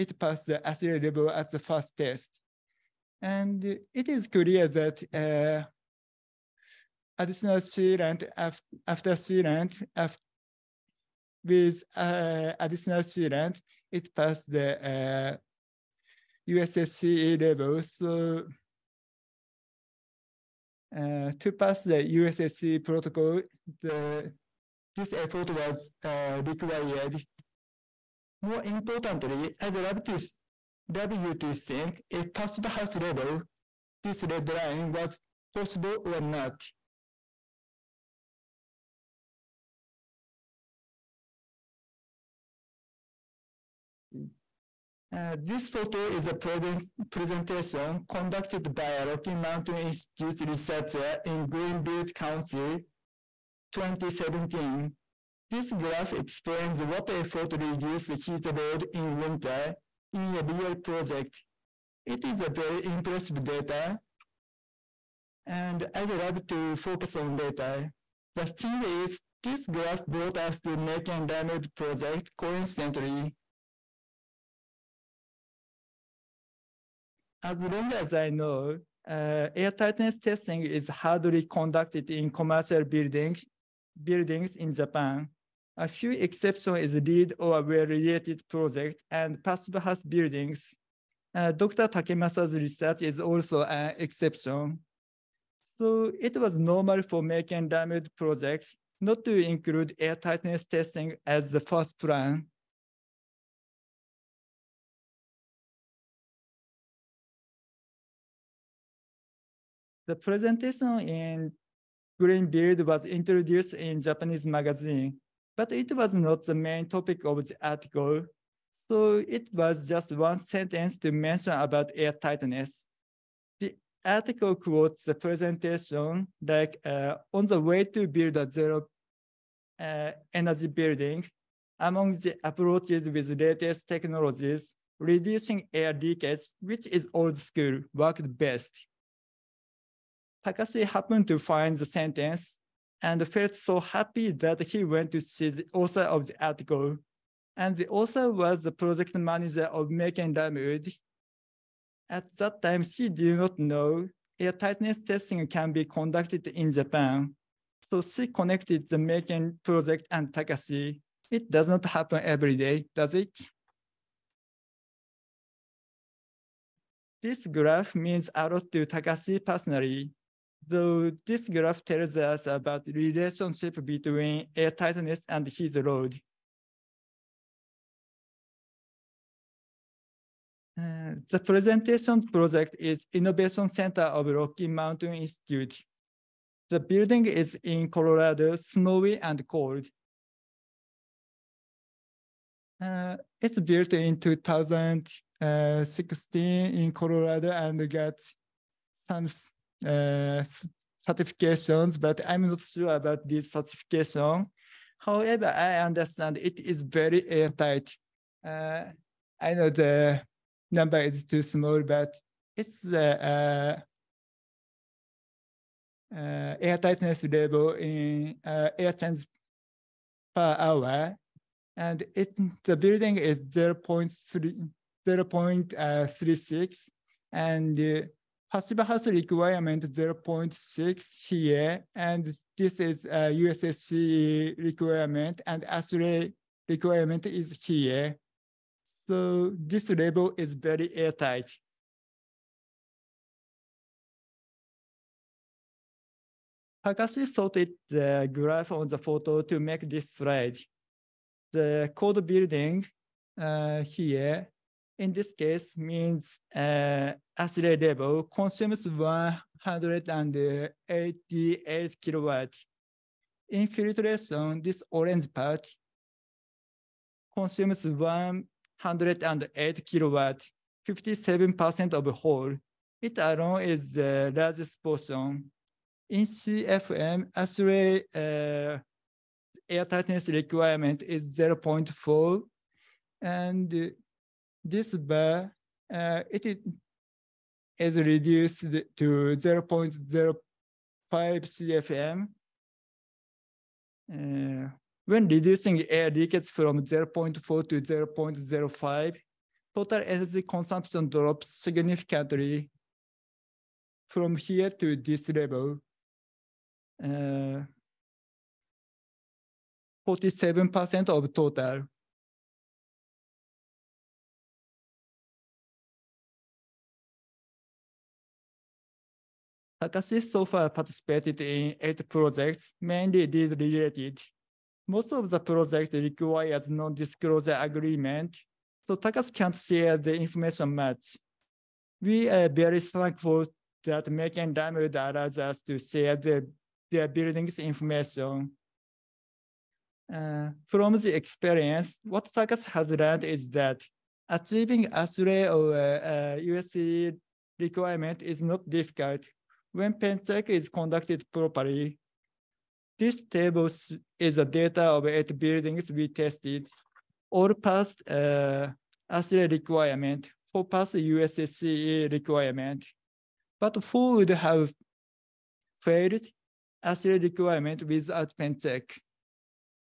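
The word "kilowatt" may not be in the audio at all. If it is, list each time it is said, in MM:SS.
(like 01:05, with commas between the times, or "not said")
04:22, 04:29.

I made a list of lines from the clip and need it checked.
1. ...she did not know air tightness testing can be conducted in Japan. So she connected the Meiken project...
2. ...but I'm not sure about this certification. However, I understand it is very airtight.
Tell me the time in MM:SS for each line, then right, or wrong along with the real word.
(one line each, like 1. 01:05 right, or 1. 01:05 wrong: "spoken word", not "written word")
1. 02:32 right
2. 03:21 right.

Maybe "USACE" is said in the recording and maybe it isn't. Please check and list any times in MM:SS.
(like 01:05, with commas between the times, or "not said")
00:16, 00:22, 03:53, 05:46, 06:00.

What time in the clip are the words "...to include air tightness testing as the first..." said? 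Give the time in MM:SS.
01:39.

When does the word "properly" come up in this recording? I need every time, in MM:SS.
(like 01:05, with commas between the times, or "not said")
05:51.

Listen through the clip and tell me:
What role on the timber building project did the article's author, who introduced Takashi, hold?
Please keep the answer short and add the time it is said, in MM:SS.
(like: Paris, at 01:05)
project manager, at 02:28.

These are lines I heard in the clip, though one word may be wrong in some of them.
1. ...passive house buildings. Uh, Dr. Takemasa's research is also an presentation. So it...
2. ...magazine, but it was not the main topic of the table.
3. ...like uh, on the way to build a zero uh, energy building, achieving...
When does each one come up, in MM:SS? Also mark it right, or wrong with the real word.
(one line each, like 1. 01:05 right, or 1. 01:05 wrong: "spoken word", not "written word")
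1. 01:29 wrong: "exception", not "presentation"
2. 01:54 wrong: "article", not "table"
3. 02:06 wrong: "among", not "achieving".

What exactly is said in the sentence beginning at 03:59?
So this label is very airtight.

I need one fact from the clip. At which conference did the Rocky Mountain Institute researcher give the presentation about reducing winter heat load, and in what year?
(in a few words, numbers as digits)
Greenbuild 2017.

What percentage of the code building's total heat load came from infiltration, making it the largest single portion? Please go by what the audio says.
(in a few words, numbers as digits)
57%.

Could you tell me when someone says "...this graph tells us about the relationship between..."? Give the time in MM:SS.
02:51.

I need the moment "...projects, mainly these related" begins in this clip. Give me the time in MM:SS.
05:22.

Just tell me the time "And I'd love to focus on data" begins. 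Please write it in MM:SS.
01:05.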